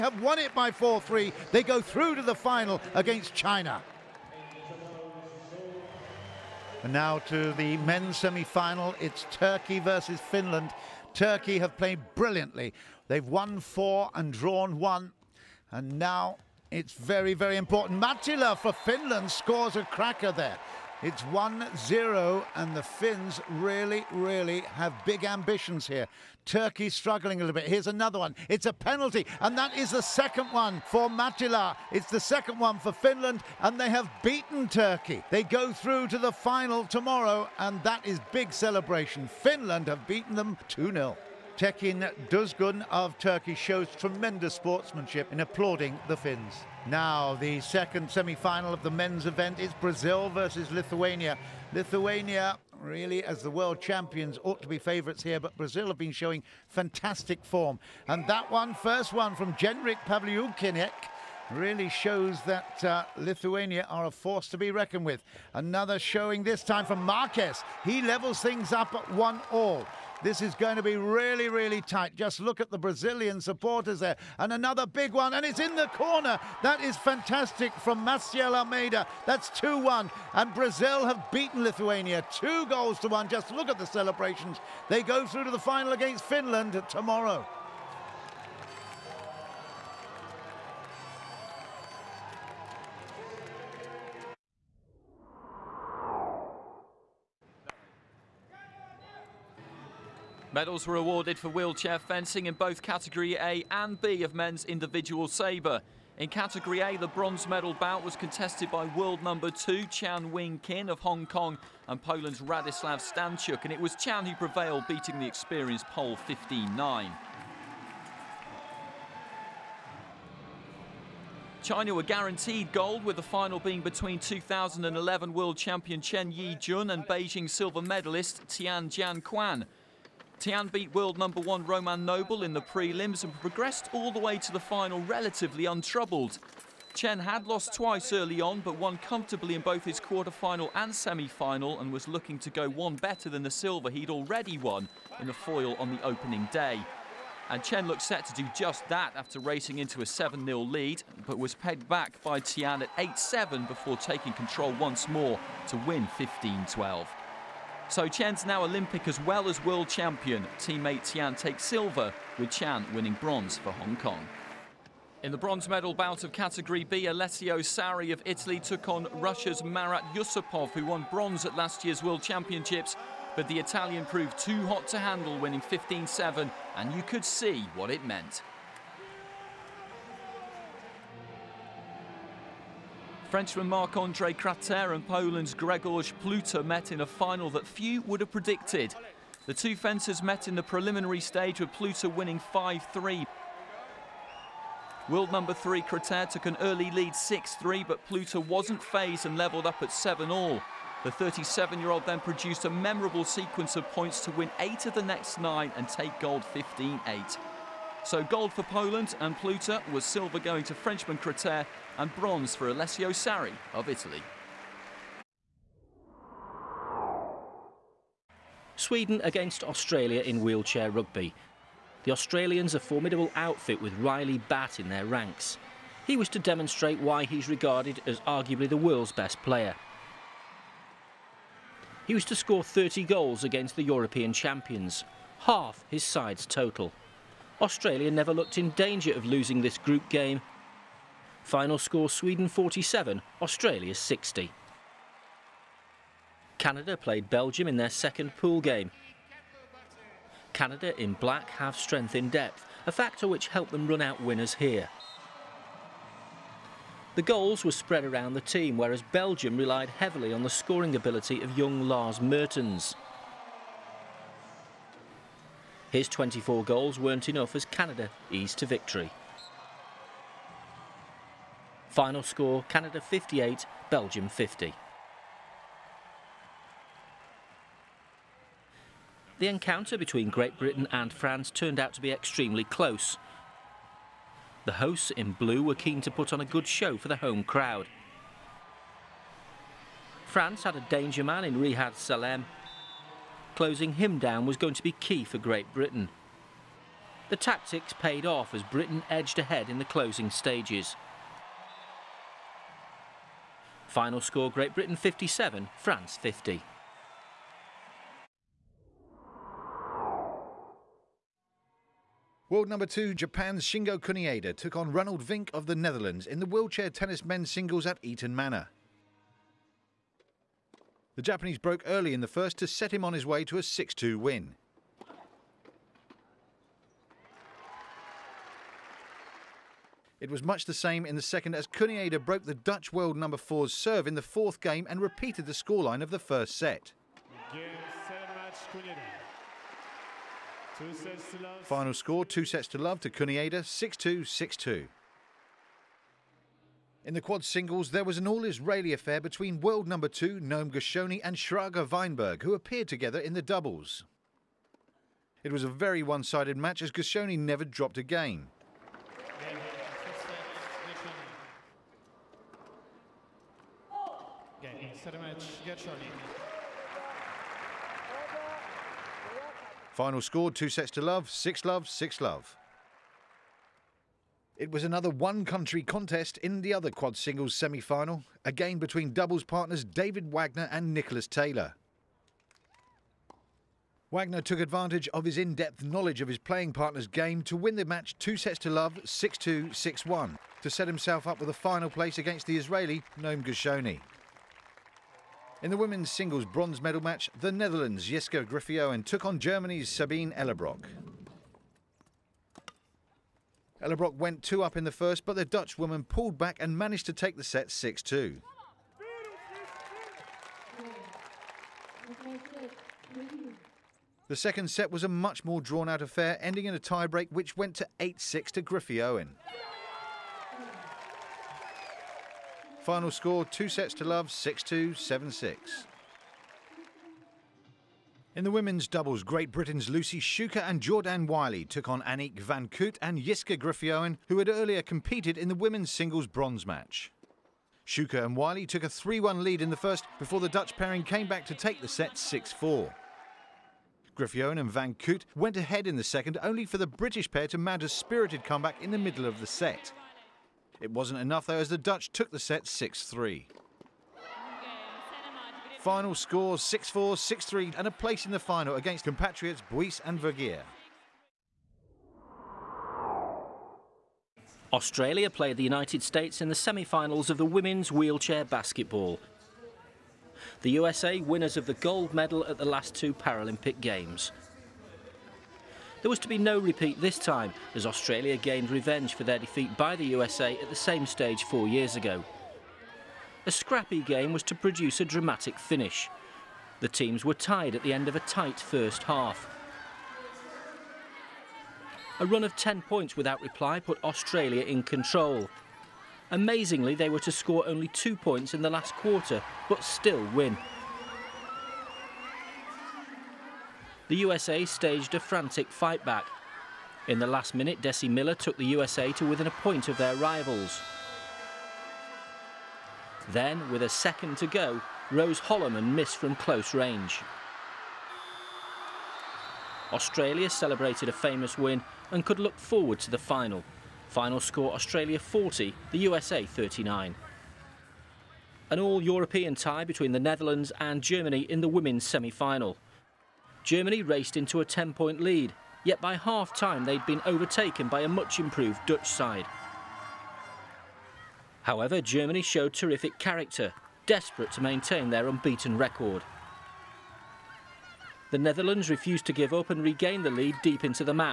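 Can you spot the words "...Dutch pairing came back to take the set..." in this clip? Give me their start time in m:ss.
7:20.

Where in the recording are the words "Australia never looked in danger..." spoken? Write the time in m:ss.
3:57.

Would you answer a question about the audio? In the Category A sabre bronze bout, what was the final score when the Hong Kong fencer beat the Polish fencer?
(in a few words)
15-9.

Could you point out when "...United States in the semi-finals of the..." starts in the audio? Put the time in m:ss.
7:45.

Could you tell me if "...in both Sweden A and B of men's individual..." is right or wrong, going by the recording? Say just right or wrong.
wrong.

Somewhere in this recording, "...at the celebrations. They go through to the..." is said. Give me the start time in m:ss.
1:23.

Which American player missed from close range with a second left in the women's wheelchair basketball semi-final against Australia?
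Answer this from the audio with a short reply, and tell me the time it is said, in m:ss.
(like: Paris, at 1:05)
Rose Hollermann, at 8:35.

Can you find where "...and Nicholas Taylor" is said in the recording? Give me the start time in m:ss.
6:20.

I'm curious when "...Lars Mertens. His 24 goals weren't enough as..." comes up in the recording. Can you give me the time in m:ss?
4:21.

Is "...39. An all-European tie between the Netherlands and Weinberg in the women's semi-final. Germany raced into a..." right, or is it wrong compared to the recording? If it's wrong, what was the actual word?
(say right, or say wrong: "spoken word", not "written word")
wrong: "Germany", not "Weinberg".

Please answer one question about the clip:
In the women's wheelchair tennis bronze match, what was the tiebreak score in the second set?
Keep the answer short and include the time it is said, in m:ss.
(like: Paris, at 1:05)
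8-6, at 6:57.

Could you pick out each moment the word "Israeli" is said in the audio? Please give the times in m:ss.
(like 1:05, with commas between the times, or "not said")
5:48, 6:32.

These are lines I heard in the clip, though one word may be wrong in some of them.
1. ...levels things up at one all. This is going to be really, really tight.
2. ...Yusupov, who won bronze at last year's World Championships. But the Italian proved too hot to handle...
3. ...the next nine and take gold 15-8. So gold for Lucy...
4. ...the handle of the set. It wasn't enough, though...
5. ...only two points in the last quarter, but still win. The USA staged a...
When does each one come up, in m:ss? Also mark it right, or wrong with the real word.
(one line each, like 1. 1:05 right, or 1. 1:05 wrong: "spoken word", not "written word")
1. 1:08 right
2. 2:50 right
3. 3:24 wrong: "Poland", not "Lucy"
4. 7:28 wrong: "middle", not "handle"
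5. 8:17 right.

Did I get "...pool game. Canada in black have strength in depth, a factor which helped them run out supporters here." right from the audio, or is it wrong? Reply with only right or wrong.
wrong.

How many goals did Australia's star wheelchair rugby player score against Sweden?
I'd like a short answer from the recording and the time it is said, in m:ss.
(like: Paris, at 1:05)
30, at 3:52.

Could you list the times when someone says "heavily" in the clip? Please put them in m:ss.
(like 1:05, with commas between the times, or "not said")
4:19.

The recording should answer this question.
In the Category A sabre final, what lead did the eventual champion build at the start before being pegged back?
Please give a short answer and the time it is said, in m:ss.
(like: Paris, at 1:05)
7-0, at 2:30.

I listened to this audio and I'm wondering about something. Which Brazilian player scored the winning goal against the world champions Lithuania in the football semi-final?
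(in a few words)
Maciel Almeida.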